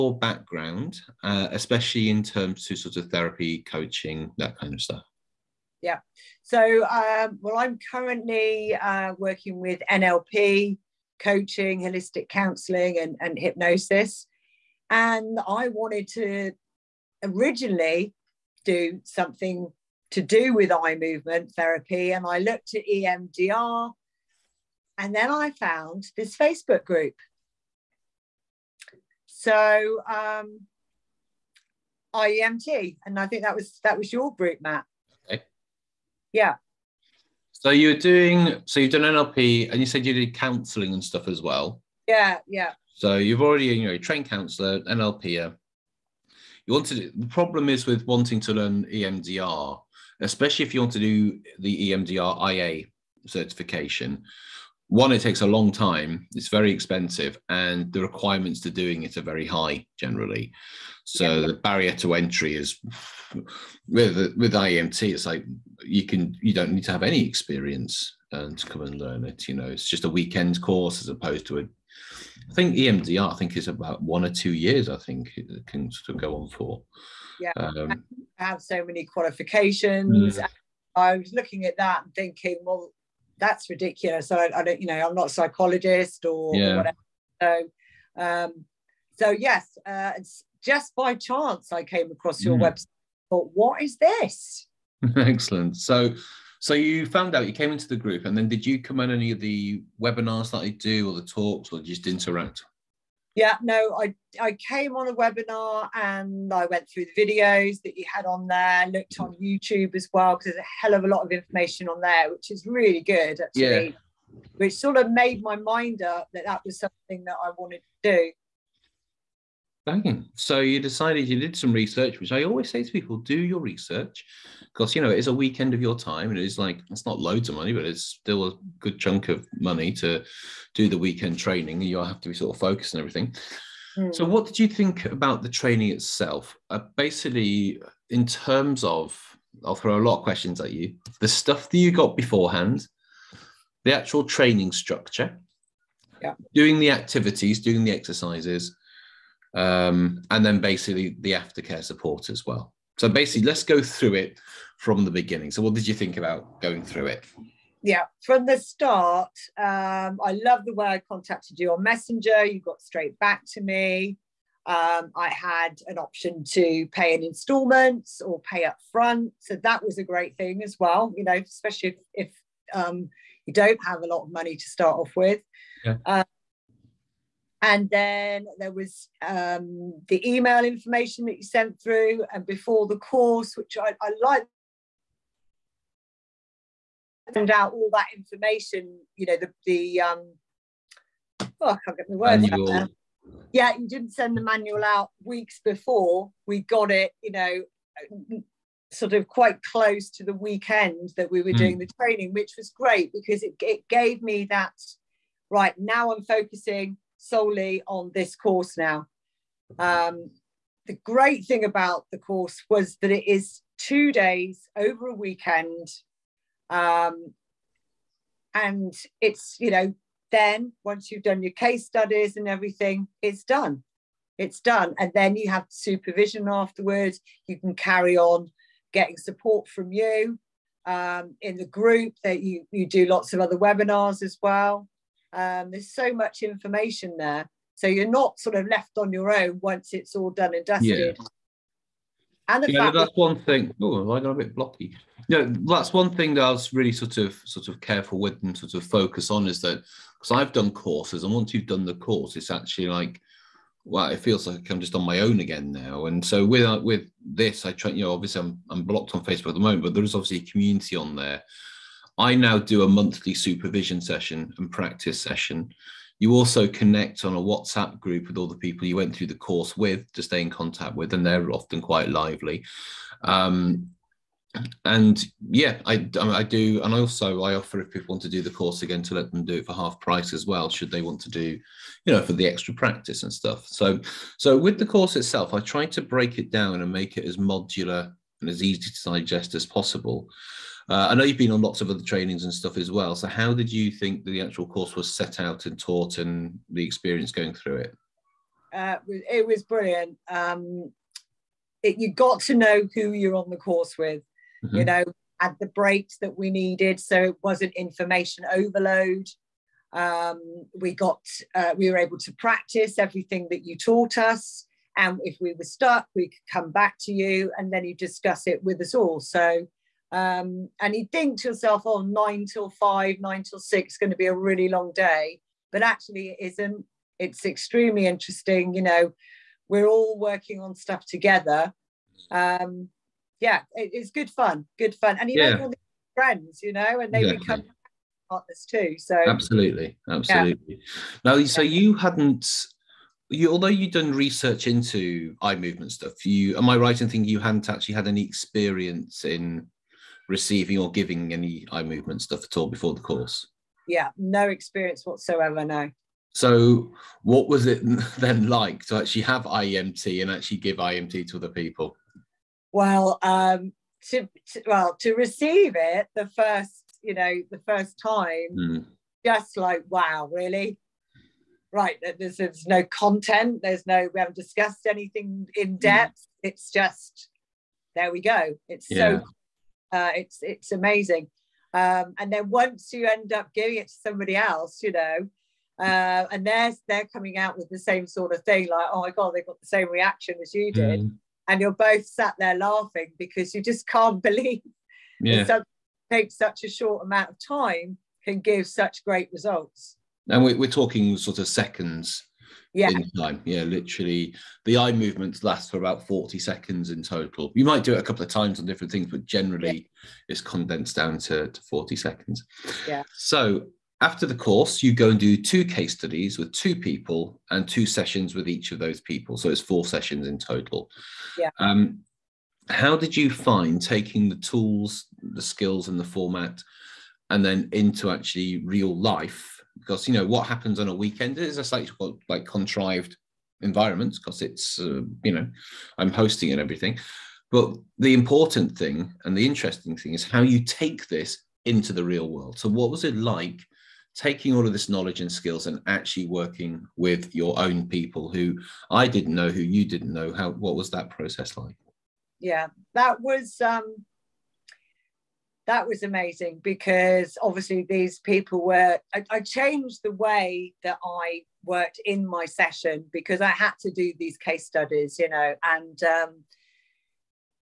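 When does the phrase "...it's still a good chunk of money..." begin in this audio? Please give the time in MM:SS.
02:07.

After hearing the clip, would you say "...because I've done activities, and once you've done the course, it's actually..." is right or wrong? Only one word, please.
wrong.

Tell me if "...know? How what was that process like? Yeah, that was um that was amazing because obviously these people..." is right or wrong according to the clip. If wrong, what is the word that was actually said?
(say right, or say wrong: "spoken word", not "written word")
right.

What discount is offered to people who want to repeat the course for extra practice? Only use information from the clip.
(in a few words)
half price.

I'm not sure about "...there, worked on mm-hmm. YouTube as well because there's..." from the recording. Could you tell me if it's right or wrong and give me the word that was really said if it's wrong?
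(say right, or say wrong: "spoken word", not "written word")
wrong: "looked", not "worked".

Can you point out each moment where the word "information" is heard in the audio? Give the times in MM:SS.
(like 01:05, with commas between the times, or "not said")
01:51, 03:00, 03:08, 03:56, 05:07.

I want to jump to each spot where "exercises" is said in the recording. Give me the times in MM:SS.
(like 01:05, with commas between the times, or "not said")
02:27.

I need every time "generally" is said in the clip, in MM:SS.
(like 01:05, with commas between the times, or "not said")
00:59, 06:49.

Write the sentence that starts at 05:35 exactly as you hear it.
make all these friends, you know, and they yeah.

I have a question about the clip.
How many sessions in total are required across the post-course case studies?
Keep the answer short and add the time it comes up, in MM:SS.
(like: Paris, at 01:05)
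4, at 06:59.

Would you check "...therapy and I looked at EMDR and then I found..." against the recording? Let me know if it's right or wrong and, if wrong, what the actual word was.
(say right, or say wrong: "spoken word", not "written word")
right.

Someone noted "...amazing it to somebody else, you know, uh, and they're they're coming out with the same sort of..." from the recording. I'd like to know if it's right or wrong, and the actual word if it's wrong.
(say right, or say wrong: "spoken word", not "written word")
wrong: "giving", not "amazing".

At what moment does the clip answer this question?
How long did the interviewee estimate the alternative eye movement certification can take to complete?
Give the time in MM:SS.
01:14.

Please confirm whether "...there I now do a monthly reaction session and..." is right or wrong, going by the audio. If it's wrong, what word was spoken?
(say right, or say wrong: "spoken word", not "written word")
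wrong: "supervision", not "reaction".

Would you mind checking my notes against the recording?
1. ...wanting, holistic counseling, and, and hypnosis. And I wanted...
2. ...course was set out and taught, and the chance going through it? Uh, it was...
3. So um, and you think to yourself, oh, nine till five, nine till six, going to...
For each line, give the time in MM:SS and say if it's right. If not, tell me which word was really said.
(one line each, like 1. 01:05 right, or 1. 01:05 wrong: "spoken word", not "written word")
1. 00:11 wrong: "coaching", not "wanting"
2. 04:54 wrong: "experience", not "chance"
3. 05:19 right.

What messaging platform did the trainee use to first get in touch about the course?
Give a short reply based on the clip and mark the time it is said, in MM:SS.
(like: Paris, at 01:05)
Messenger, at 02:41.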